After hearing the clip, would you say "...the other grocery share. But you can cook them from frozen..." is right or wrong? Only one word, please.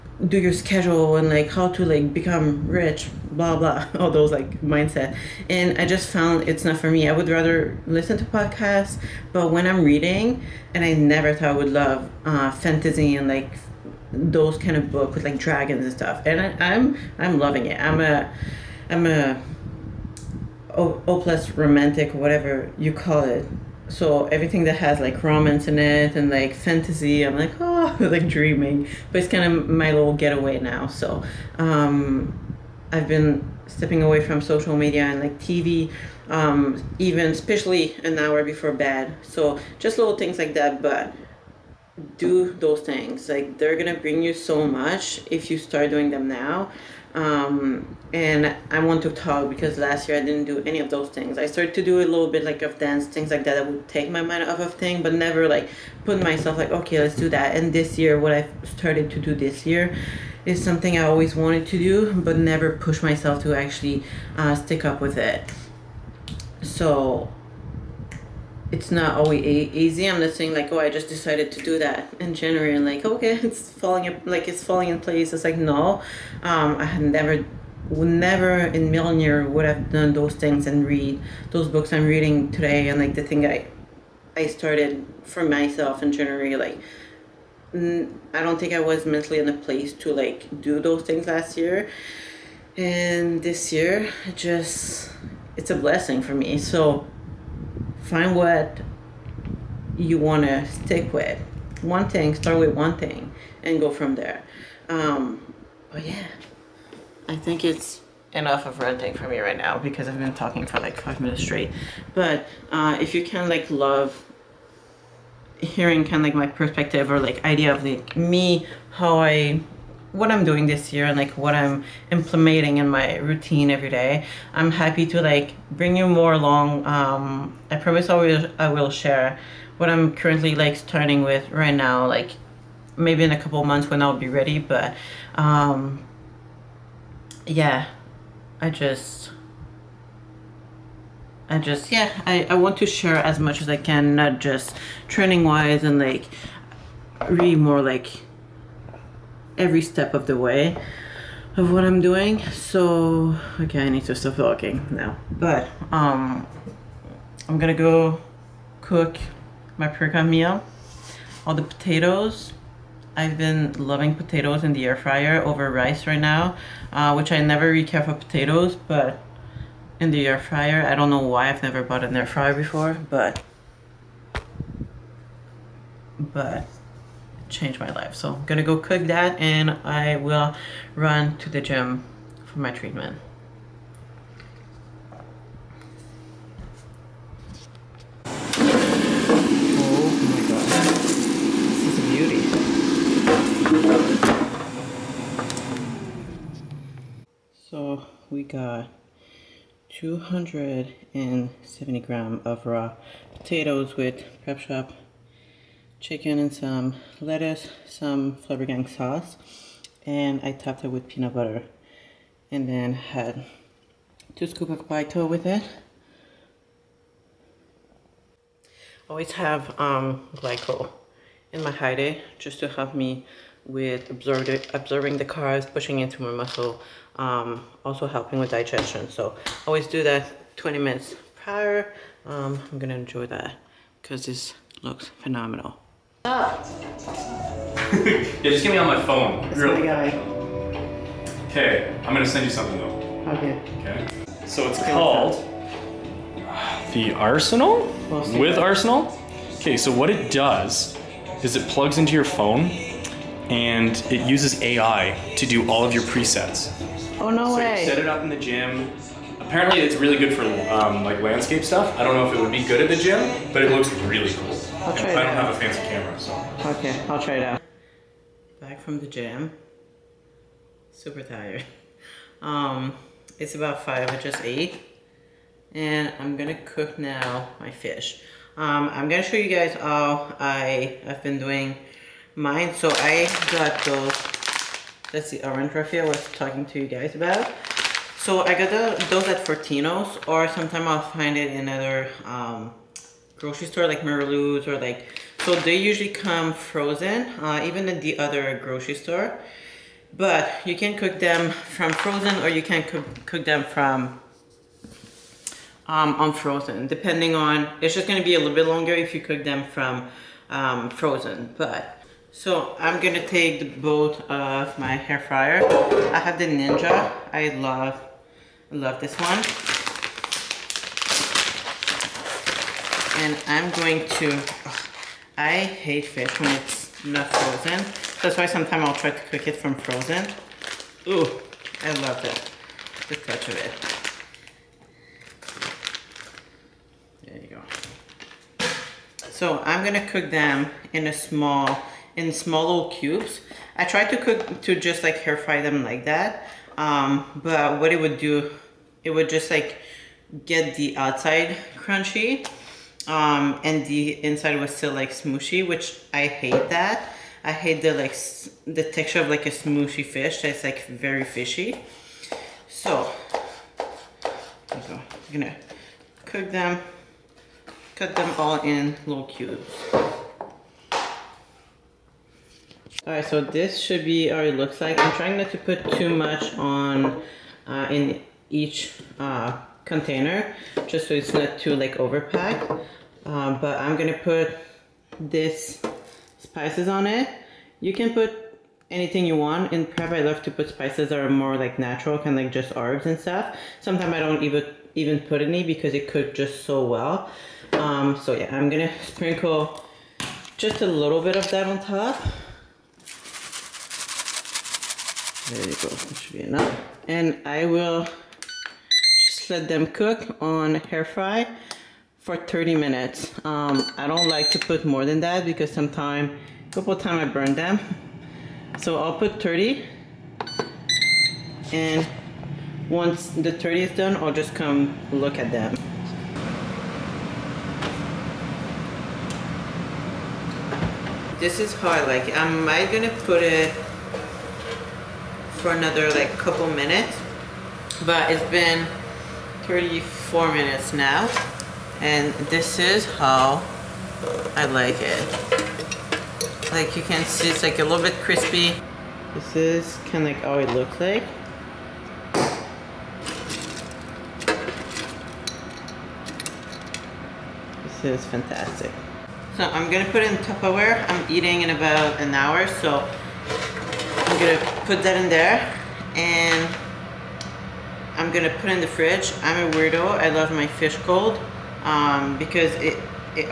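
wrong.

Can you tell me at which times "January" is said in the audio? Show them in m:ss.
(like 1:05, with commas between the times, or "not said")
1:12, 1:26.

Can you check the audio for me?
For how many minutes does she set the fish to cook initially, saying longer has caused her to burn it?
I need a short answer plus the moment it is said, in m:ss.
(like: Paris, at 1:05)
30, at 6:52.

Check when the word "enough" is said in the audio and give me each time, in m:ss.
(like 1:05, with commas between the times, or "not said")
1:48, 6:46.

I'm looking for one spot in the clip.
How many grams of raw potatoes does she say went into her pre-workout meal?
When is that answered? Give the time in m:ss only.
3:19.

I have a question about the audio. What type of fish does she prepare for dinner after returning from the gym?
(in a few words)
Orange roughy.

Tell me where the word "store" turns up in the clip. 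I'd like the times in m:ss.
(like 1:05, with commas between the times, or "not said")
4:53, 4:58.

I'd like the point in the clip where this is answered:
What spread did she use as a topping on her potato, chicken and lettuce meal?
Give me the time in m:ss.
3:31.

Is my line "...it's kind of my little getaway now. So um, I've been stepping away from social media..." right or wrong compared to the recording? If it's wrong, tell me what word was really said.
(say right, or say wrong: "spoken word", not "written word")
right.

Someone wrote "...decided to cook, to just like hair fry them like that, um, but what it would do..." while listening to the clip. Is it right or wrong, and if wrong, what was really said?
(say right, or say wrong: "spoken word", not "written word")
wrong: "tried", not "decided".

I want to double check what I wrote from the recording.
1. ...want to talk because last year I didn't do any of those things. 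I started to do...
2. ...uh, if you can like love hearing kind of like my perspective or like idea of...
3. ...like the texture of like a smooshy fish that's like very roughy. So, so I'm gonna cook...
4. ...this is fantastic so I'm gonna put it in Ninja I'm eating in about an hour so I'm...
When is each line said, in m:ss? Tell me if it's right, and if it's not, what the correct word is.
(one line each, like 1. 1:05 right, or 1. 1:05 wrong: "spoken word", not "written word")
1. 0:48 right
2. 1:52 right
3. 5:57 wrong: "fishy", not "roughy"
4. 7:37 wrong: "Tupperware", not "Ninja".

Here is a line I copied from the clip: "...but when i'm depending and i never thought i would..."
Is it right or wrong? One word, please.
wrong.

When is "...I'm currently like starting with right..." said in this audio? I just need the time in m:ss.
2:09.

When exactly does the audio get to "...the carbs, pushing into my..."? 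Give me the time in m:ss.
3:45.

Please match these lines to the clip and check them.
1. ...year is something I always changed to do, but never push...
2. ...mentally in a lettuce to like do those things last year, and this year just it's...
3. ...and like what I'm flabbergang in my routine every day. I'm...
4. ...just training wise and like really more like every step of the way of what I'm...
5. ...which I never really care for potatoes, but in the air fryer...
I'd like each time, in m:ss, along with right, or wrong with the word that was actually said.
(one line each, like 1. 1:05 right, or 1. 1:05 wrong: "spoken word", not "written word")
1. 0:59 wrong: "wanted", not "changed"
2. 1:29 wrong: "place", not "lettuce"
3. 2:01 wrong: "implementing", not "flabbergang"
4. 2:24 right
5. 2:47 right.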